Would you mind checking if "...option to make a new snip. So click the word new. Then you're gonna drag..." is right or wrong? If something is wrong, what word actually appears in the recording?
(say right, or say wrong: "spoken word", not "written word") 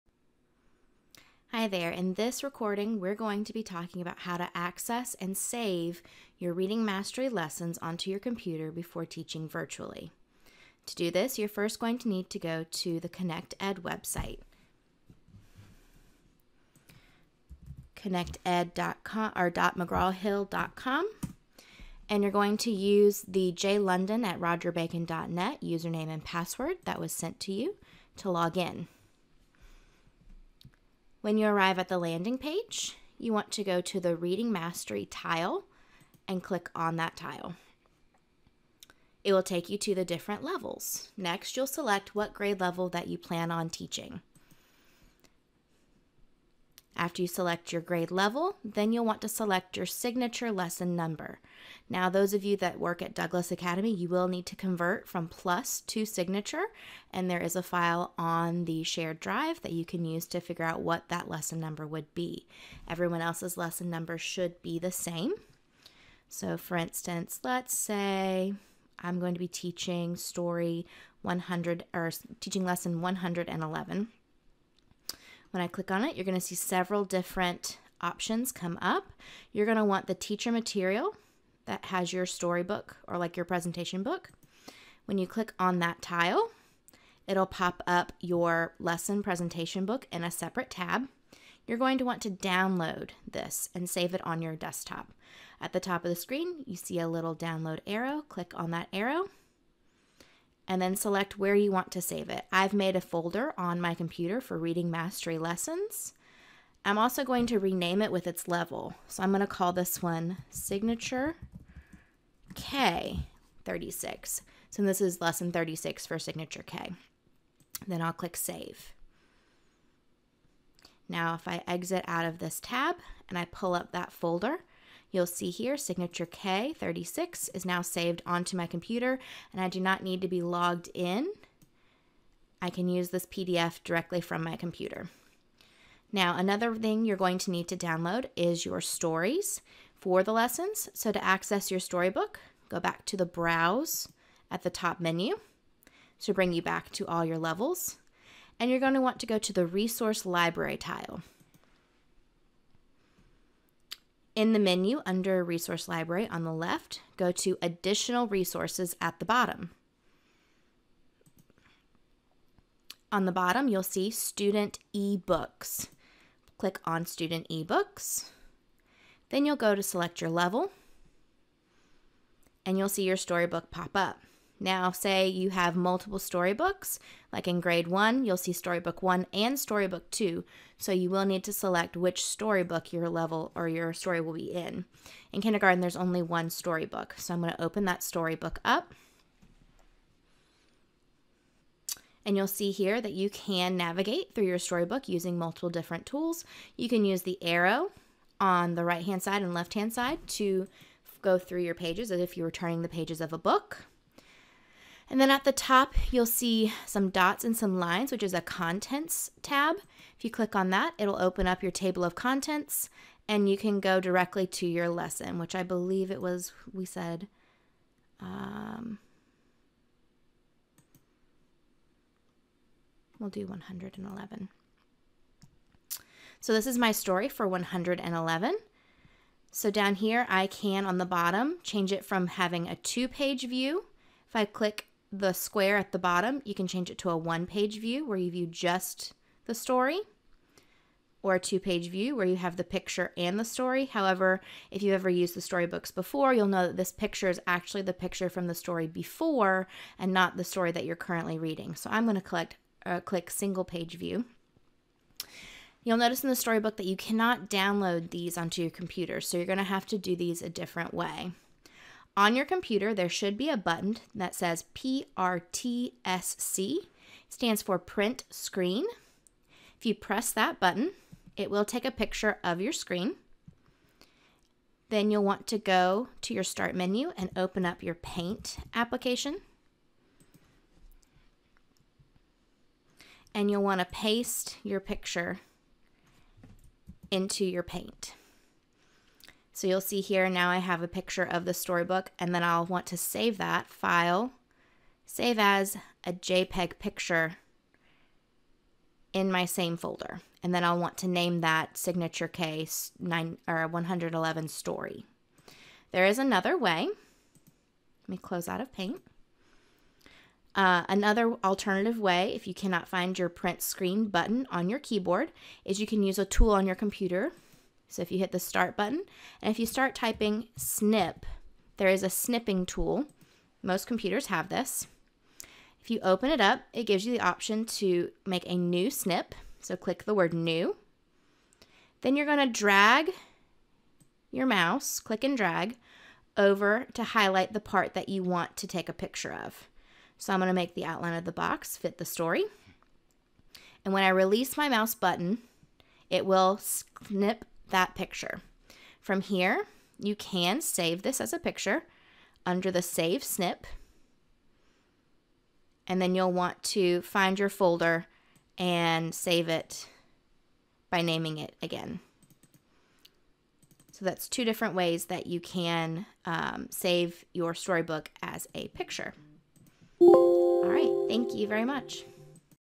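right.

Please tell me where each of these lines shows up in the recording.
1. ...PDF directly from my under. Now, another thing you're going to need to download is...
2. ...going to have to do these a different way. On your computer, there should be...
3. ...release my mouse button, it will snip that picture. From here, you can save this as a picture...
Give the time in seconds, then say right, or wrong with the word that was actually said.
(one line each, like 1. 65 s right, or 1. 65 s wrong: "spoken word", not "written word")
1. 133 s wrong: "computer", not "under"
2. 259 s right
3. 344 s right.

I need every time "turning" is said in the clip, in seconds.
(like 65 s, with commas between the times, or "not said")
202 s.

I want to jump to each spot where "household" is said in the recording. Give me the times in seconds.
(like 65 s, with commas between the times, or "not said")
not said.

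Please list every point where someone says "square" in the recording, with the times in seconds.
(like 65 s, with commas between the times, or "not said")
235 s.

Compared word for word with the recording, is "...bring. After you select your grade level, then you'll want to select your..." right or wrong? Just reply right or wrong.
wrong.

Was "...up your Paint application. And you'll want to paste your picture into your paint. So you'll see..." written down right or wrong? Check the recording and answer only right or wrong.
right.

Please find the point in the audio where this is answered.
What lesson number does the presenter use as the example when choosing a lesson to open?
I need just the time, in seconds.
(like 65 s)
72 s.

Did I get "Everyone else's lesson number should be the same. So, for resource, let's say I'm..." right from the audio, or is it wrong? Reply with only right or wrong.
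wrong.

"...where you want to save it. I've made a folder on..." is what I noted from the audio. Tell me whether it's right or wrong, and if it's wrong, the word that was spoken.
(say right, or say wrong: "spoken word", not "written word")
right.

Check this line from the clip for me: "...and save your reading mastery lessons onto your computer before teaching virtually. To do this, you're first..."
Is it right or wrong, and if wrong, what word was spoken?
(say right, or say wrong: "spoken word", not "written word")
right.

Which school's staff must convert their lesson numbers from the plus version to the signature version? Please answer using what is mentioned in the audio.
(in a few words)
Douglas Academy.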